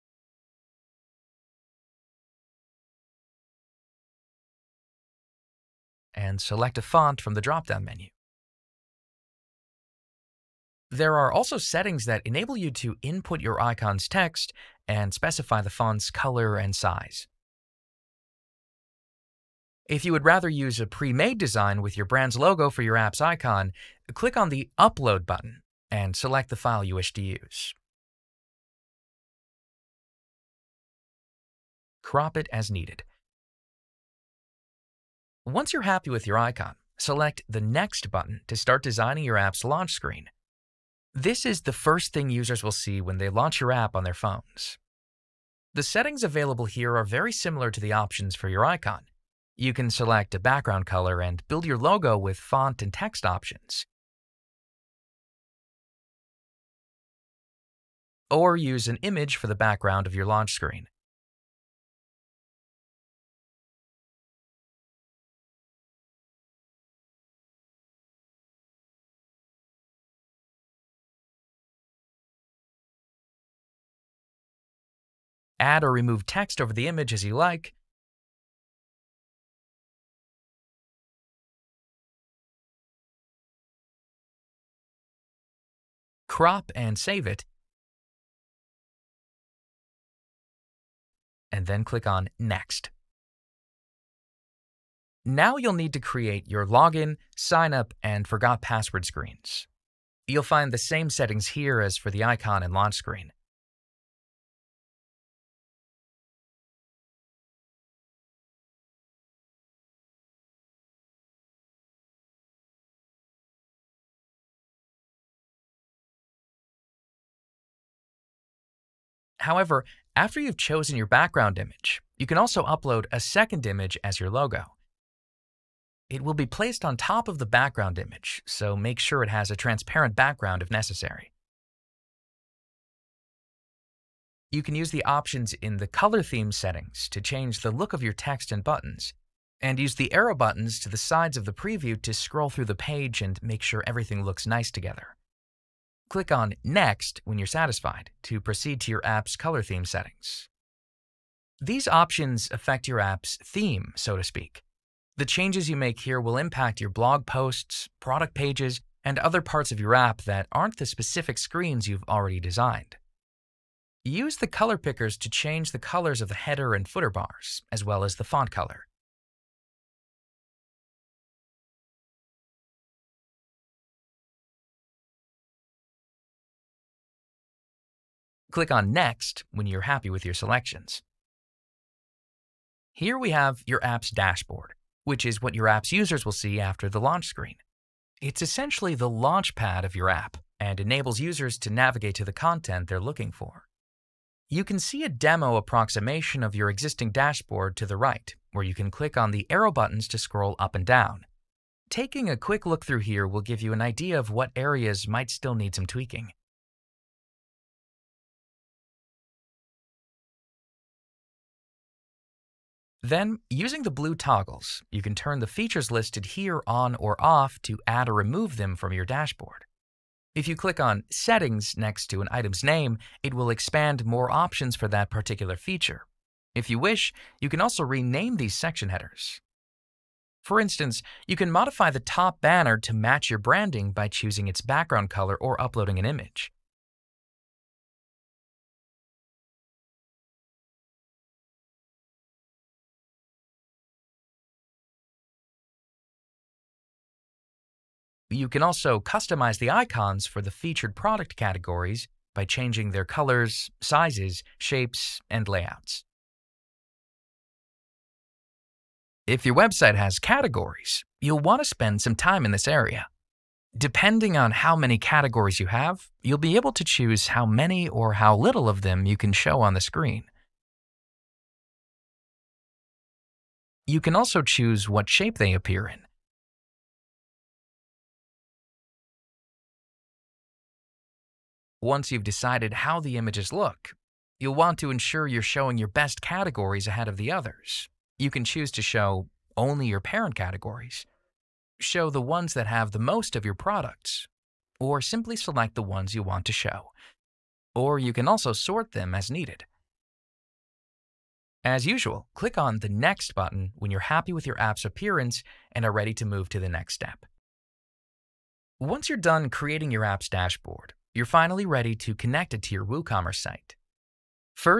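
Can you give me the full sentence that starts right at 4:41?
Once you've decided how the images look, you'll want to ensure you're showing your best categories ahead of the others.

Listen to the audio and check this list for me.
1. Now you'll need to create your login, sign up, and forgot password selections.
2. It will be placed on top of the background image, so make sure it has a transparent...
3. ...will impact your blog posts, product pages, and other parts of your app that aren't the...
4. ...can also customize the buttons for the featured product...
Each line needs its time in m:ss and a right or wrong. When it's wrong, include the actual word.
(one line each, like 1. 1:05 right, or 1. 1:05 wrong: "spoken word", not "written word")
1. 1:35 wrong: "screens", not "selections"
2. 2:06 right
3. 2:36 right
4. 4:08 wrong: "icons", not "buttons".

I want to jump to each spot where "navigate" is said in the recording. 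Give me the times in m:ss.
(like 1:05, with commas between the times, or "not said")
3:11.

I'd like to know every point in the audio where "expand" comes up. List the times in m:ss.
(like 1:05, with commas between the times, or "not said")
3:43.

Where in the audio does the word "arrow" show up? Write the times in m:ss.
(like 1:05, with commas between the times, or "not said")
2:20, 3:19.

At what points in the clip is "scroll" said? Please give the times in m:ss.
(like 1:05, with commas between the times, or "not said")
2:22, 3:20.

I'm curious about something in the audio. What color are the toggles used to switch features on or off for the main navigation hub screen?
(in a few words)
blue.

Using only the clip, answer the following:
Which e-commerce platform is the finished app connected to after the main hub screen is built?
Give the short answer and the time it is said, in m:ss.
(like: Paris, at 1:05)
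WooCommerce, at 5:12.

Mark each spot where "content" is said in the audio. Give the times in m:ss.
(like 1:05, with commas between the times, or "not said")
3:12.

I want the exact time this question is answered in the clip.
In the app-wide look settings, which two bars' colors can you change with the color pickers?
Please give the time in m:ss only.
2:46.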